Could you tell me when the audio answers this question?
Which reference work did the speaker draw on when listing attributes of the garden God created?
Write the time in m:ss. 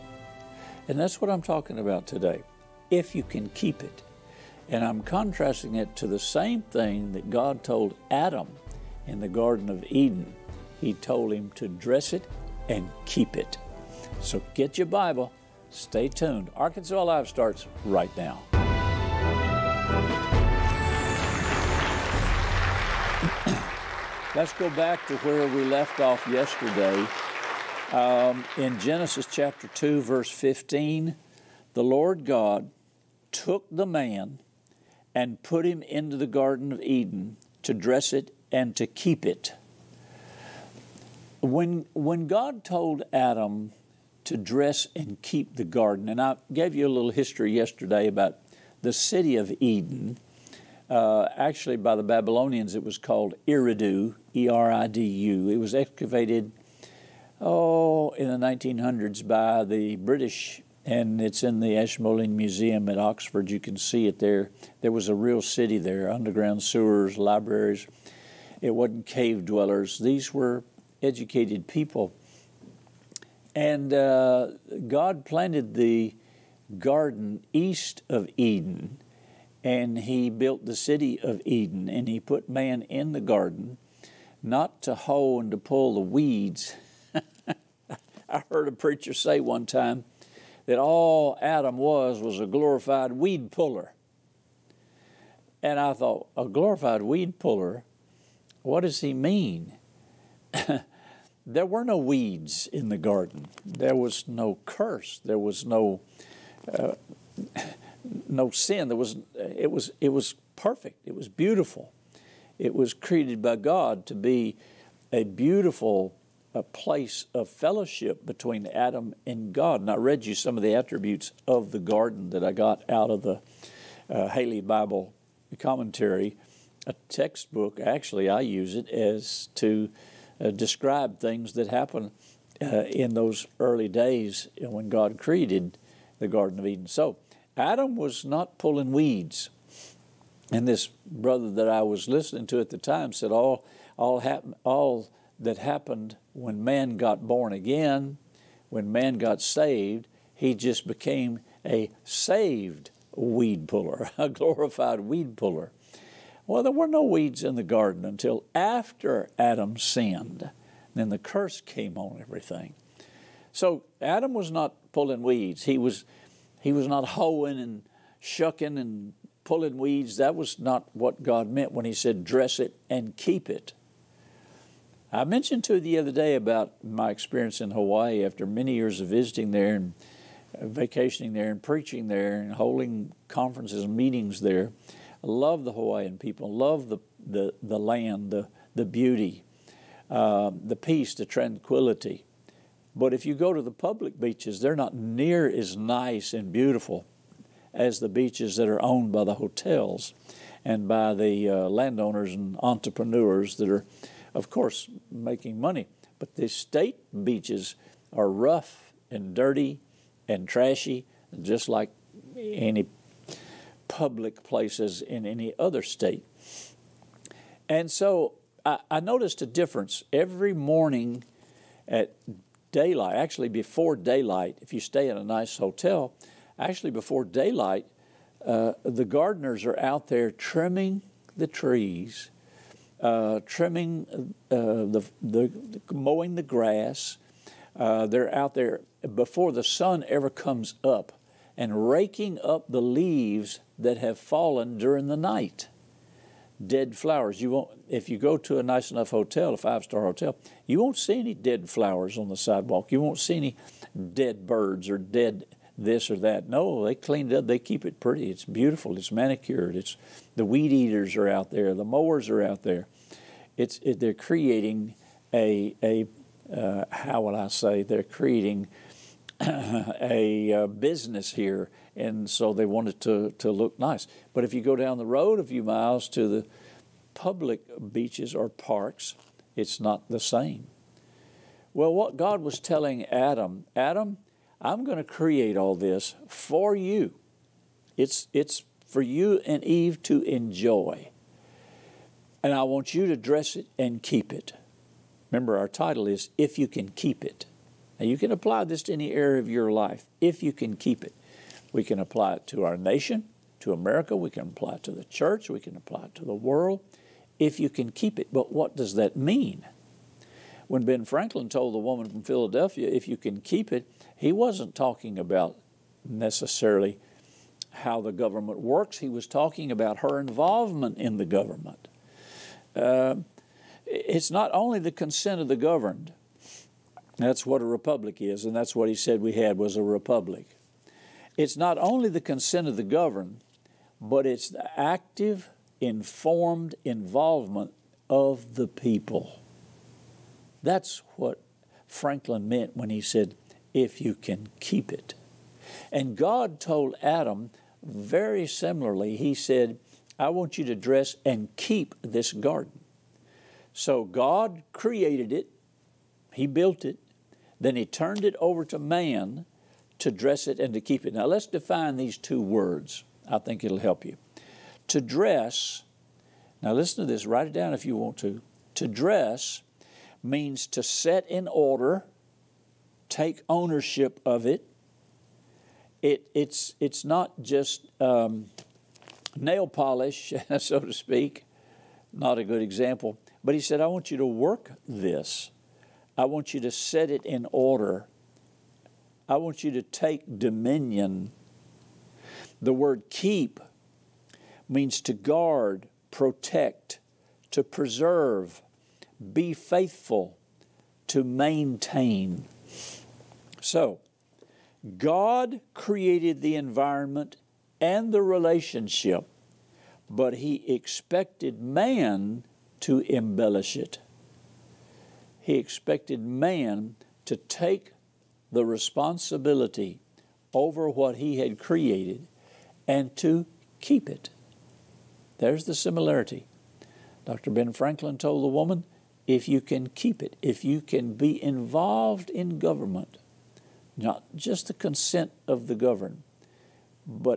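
2:04.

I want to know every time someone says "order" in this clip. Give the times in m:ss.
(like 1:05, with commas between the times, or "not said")
6:11, 6:27.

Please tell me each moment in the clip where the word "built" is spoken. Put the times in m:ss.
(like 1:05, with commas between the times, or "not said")
1:20, 5:56.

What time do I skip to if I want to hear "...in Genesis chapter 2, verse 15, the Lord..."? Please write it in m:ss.
0:28.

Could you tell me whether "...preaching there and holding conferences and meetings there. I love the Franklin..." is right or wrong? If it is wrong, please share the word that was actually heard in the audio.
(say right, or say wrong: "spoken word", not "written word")
wrong: "Hawaiian", not "Franklin".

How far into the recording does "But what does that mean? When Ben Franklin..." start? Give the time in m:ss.
5:08.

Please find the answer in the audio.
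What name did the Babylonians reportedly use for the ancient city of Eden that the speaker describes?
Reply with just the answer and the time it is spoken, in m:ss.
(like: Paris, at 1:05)
Eridu, at 0:53.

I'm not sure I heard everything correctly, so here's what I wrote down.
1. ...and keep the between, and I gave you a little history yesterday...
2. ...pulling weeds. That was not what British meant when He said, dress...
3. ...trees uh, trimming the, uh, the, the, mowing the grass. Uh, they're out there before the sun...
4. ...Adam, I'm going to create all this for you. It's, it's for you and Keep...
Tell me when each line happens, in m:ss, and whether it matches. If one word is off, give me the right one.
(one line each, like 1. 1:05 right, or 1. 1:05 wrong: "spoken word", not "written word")
1. 0:44 wrong: "garden", not "between"
2. 2:49 wrong: "God", not "British"
3. 3:51 right
4. 4:43 wrong: "Eve", not "Keep".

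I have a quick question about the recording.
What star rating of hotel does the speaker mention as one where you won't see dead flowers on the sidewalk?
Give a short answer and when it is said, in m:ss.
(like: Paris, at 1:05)
5 star, at 4:09.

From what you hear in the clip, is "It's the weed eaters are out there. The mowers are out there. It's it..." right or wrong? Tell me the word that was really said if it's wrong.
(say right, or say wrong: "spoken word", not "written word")
right.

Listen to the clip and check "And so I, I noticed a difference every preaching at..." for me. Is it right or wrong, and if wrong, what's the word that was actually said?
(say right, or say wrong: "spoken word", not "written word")
wrong: "morning", not "preaching".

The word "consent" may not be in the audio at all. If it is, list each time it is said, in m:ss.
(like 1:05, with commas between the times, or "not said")
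5:24, 5:32, 7:14.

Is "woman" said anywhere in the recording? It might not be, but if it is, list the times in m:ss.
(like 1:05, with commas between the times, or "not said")
5:11, 7:08.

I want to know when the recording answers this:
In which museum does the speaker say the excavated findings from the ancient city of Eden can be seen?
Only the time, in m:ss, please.
1:01.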